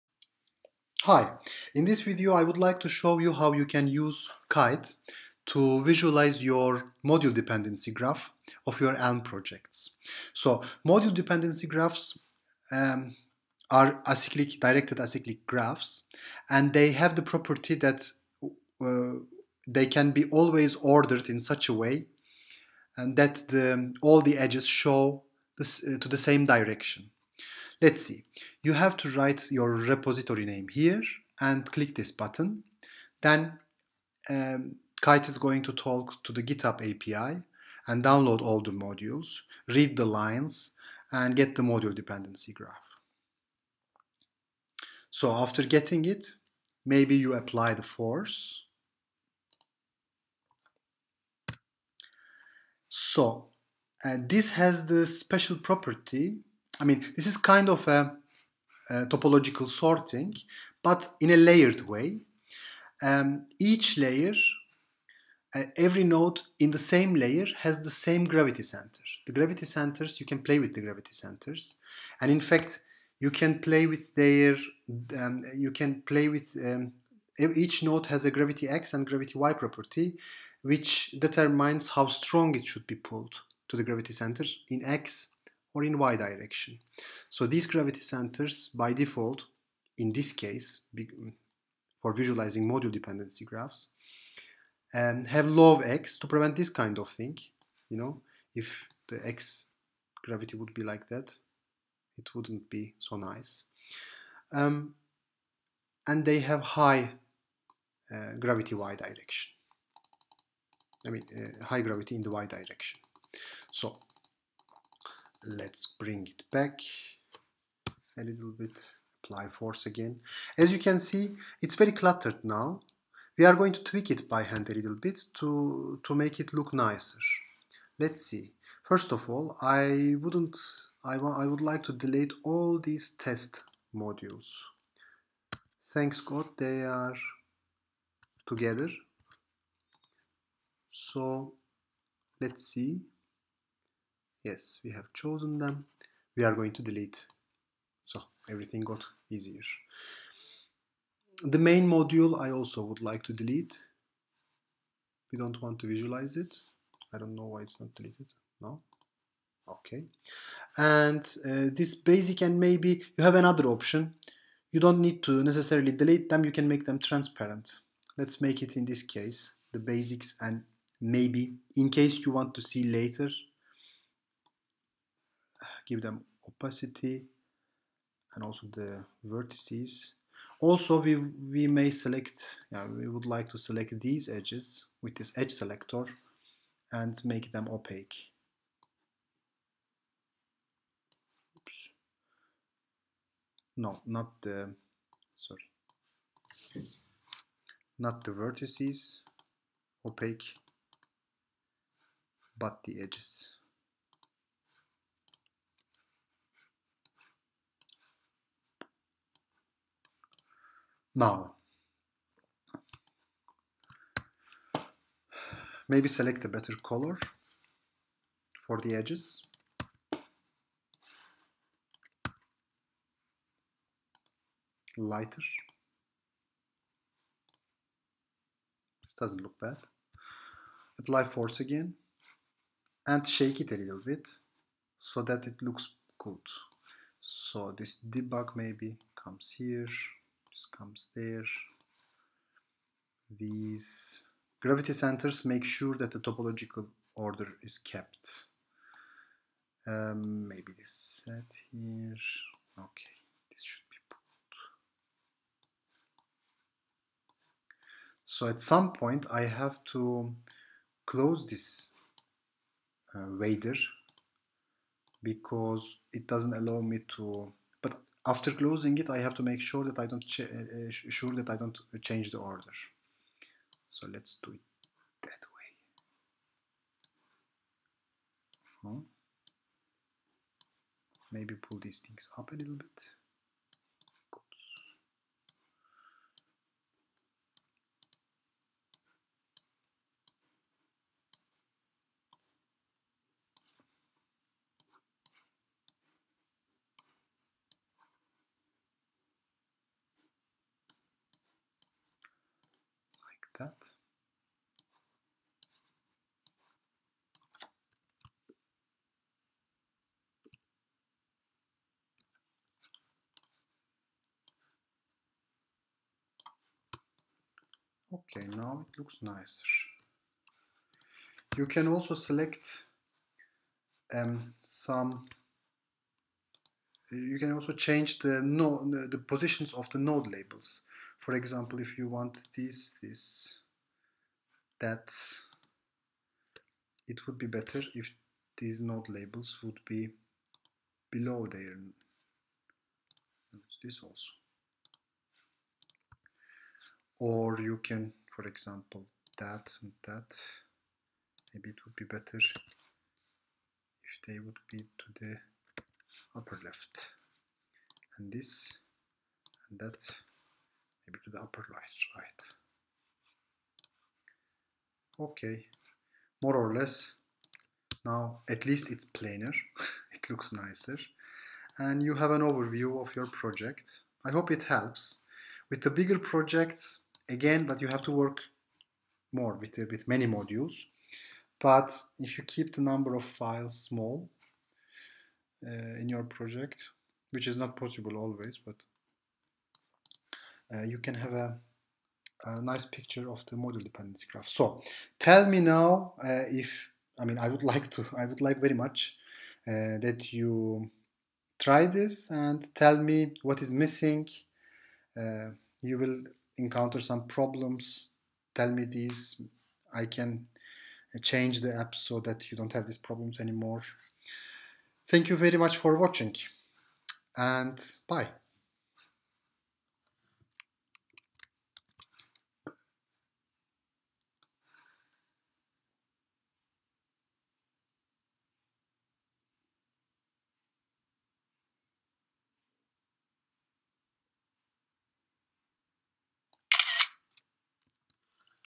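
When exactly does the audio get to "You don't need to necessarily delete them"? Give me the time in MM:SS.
02:44.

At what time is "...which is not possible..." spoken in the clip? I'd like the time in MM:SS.
06:27.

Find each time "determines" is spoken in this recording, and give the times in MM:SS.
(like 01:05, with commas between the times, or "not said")
01:21.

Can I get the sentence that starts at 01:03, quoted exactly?
Um, each layer, uh, every node in the same layer has the same gravity center.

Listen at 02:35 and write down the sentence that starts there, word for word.
We don't want to visualize it.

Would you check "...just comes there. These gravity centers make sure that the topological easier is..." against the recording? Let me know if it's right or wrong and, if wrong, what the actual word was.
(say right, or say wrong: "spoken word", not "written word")
wrong: "order", not "easier".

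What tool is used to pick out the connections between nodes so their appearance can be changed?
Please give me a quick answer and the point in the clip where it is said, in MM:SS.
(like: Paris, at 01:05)
edge selector, at 03:05.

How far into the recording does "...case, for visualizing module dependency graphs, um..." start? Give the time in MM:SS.
01:30.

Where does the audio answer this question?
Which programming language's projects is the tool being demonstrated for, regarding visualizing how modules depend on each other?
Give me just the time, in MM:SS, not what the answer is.
00:08.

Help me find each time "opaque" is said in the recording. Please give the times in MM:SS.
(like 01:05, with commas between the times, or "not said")
03:07, 03:20.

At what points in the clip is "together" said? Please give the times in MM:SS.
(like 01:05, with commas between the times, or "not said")
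02:18.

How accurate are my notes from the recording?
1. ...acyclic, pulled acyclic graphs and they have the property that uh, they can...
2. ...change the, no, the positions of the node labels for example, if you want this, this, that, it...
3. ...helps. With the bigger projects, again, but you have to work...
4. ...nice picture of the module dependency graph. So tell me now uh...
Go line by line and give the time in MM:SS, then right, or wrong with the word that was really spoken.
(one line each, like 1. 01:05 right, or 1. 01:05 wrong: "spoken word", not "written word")
1. 00:14 wrong: "directed", not "pulled"
2. 05:27 right
3. 06:14 right
4. 06:32 right.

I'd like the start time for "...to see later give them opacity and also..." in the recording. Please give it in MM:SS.
02:52.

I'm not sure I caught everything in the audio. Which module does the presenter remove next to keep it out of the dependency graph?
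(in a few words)
main module.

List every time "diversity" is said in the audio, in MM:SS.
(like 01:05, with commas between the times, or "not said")
not said.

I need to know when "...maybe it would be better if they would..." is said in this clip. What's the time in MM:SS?
05:51.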